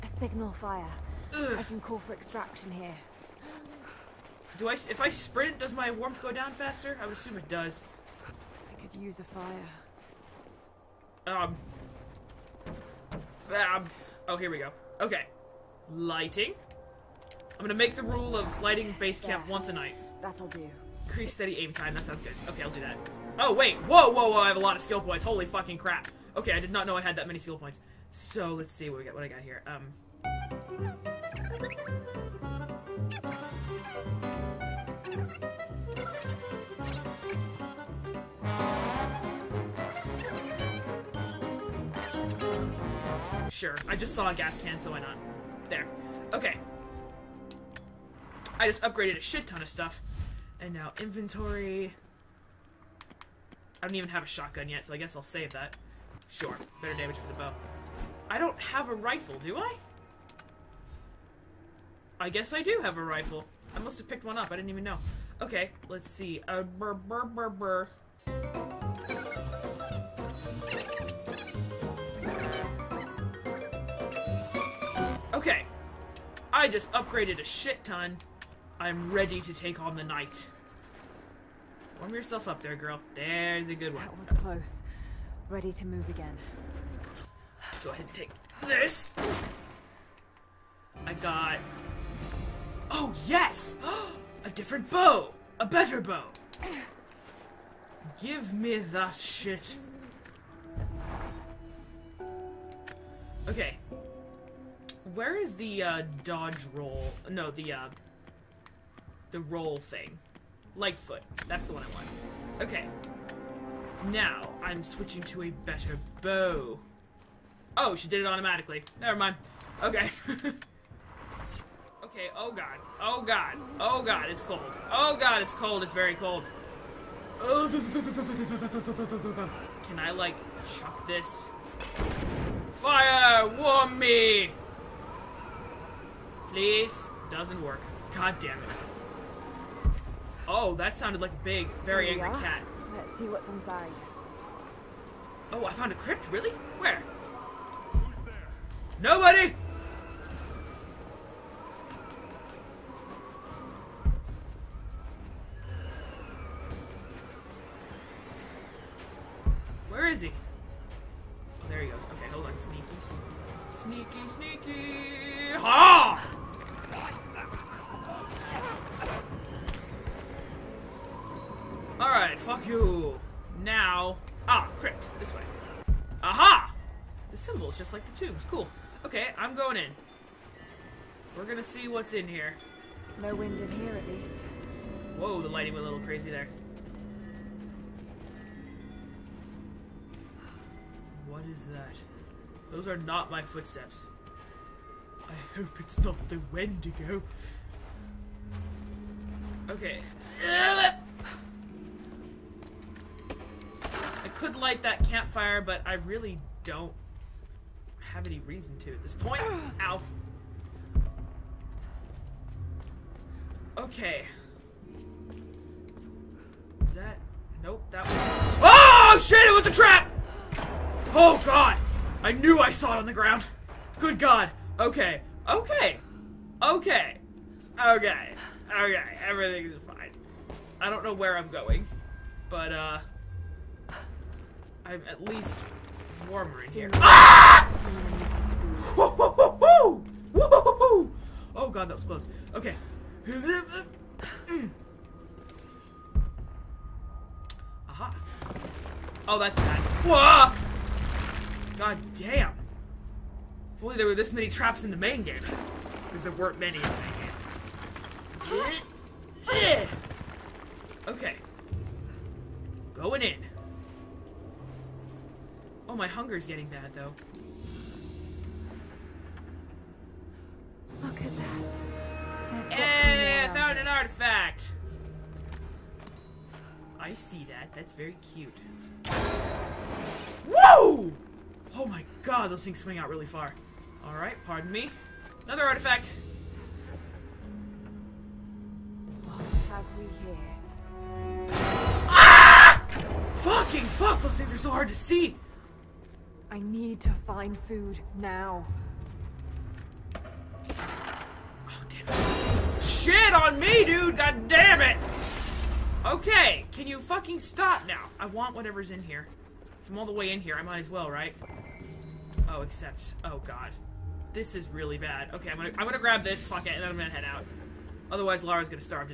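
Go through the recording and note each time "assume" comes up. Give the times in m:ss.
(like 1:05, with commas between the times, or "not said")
0:07.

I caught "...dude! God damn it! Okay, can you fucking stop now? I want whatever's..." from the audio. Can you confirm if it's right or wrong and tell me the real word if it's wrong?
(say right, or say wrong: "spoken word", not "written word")
right.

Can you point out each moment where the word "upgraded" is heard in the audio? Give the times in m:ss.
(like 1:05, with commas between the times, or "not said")
0:48, 1:16.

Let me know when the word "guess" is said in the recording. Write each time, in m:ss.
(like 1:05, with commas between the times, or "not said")
0:54, 1:02.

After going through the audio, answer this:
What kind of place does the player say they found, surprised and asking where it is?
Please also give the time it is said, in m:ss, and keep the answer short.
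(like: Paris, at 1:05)
A crypt, at 2:25.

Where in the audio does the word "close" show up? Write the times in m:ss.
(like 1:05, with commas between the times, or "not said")
1:24, 4:02.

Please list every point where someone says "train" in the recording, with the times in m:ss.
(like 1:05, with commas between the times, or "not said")
not said.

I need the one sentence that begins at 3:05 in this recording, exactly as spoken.
Whoa, the lighting went a little crazy there.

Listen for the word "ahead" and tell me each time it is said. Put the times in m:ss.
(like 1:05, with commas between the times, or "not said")
1:27.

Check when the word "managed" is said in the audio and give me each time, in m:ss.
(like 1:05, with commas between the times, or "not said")
not said.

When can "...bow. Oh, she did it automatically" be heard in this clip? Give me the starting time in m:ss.
1:56.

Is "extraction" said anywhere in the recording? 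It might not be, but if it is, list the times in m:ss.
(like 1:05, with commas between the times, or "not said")
0:02.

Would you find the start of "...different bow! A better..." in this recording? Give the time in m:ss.
1:34.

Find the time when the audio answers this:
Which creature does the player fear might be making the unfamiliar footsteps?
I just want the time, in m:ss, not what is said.
3:16.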